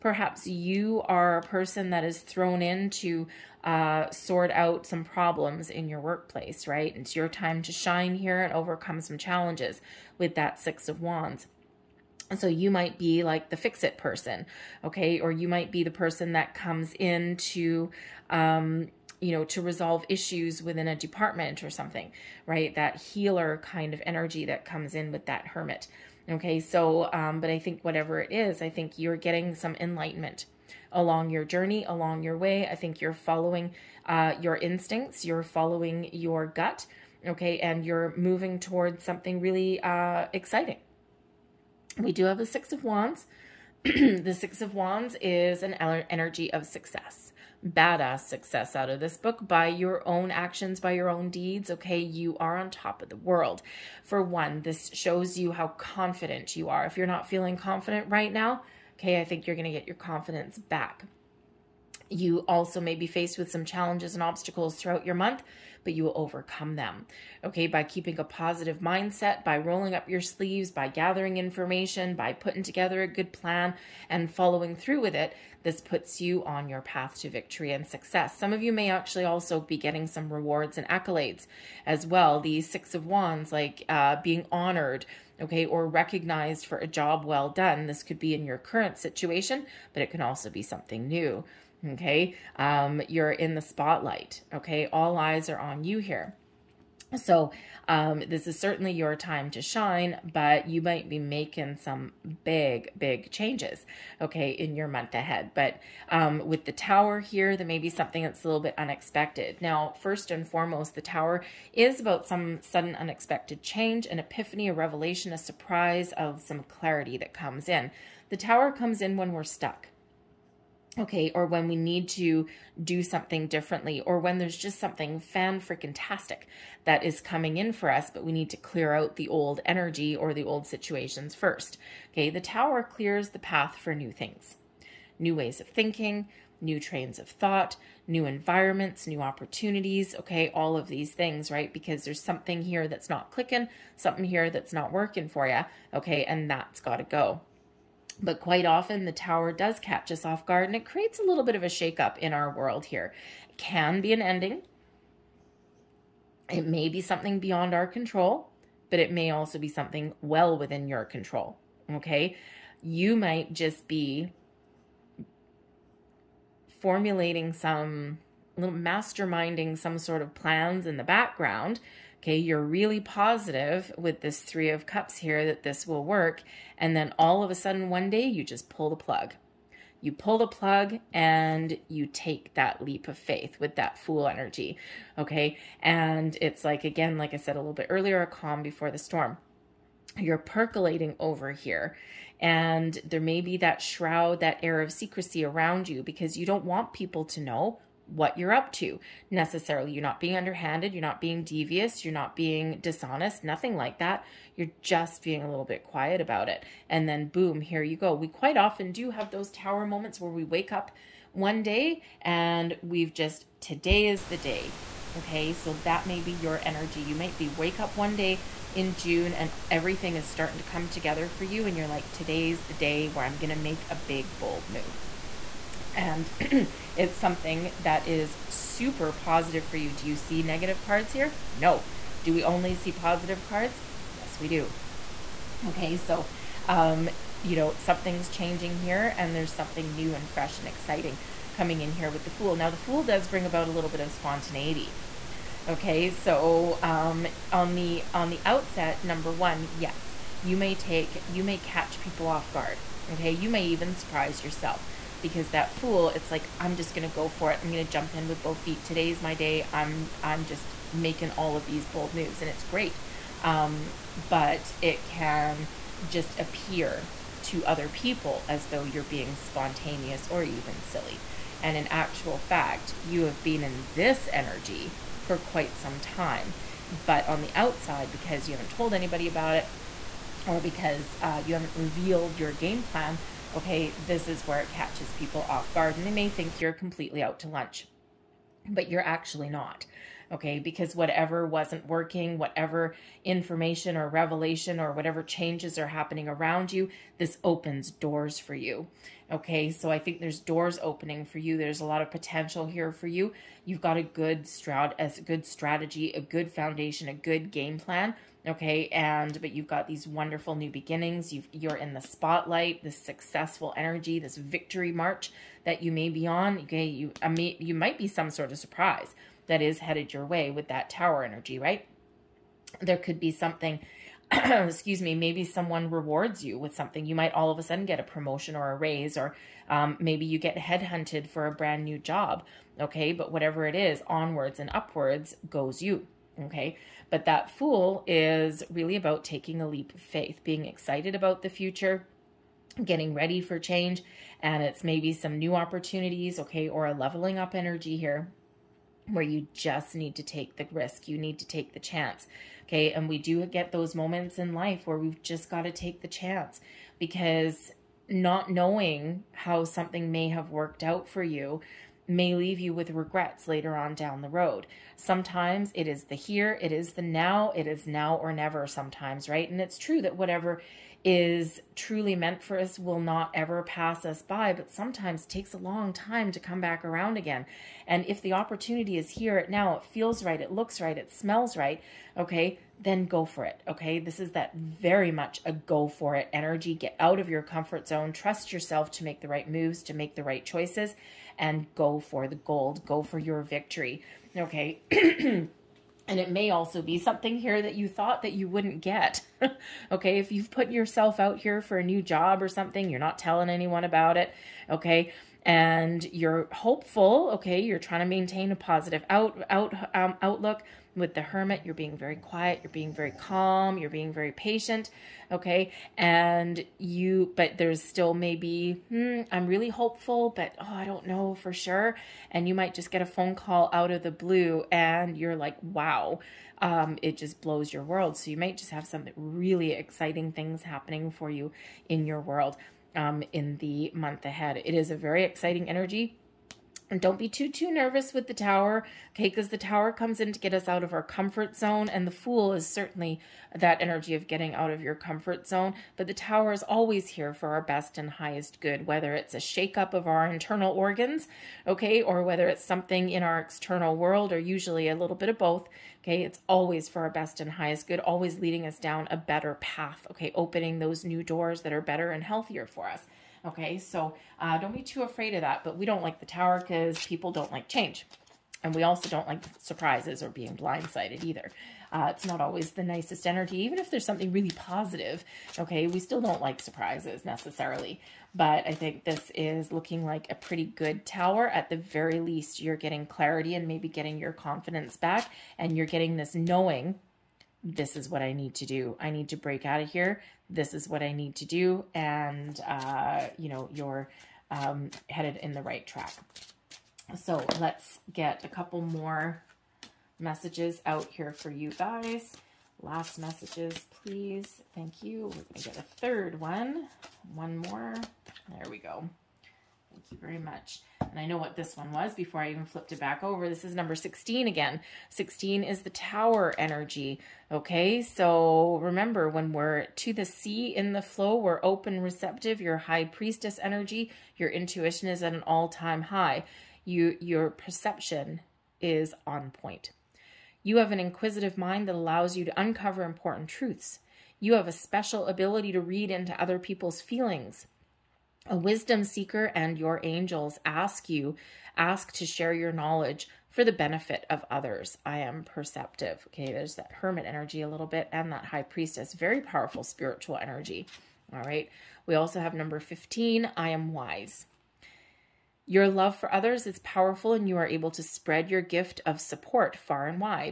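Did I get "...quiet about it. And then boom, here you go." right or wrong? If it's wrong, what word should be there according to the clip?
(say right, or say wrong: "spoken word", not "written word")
right.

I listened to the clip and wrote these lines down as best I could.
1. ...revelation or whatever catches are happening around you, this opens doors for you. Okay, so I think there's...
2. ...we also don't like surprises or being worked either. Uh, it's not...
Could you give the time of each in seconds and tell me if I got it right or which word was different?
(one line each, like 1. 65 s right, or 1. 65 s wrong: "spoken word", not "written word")
1. 294 s wrong: "changes", not "catches"
2. 468 s wrong: "blindsided", not "worked".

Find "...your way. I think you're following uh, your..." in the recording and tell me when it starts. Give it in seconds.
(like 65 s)
32 s.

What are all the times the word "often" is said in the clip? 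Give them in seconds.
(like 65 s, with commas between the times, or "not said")
148 s, 208 s.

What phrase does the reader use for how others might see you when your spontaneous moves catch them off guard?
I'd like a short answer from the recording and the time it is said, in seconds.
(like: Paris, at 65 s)
Out to lunch, at 287 s.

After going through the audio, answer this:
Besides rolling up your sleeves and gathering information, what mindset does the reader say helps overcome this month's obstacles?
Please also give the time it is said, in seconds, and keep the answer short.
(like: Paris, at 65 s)
A positive mindset, at 68 s.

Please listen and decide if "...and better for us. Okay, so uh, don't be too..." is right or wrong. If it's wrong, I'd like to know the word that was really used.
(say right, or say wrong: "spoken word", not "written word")
wrong: "healthier", not "better".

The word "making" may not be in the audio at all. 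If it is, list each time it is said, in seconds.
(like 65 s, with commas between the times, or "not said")
101 s, 260 s.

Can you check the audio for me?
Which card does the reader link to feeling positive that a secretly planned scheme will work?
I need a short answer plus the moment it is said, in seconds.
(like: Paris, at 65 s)
Three of Cups, at 174 s.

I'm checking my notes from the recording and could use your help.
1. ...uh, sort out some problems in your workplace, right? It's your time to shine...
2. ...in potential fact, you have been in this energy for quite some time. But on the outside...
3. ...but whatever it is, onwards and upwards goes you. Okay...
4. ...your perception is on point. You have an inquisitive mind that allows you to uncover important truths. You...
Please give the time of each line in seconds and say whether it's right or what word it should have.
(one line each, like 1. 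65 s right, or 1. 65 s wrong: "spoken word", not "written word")
1. 3 s right
2. 271 s wrong: "actual", not "potential"
3. 333 s right
4. 527 s right.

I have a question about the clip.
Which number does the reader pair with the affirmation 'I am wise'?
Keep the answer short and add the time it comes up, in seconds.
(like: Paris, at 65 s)
15, at 552 s.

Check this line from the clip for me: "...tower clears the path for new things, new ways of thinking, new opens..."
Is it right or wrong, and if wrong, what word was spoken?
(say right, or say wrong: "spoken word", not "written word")
wrong: "trains", not "opens".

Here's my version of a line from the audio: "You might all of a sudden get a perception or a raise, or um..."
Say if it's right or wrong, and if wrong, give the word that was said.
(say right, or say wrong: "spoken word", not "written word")
wrong: "promotion", not "perception".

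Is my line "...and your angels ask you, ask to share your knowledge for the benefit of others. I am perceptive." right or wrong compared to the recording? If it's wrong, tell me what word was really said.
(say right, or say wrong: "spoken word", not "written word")
right.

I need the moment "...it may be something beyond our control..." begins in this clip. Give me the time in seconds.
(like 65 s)
156 s.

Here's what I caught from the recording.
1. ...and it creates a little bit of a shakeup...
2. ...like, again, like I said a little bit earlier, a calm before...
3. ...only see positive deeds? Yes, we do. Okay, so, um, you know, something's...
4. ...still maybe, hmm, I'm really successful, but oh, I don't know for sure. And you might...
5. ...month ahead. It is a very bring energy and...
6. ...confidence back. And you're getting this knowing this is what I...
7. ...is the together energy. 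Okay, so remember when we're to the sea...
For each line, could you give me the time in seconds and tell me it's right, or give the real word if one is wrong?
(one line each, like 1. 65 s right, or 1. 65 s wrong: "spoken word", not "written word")
1. 150 s right
2. 186 s right
3. 232 s wrong: "cards", not "deeds"
4. 417 s wrong: "hopeful", not "successful"
5. 433 s wrong: "exciting", not "bring"
6. 484 s right
7. 515 s wrong: "tower", not "together".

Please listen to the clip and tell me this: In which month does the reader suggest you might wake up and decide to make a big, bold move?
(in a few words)
June.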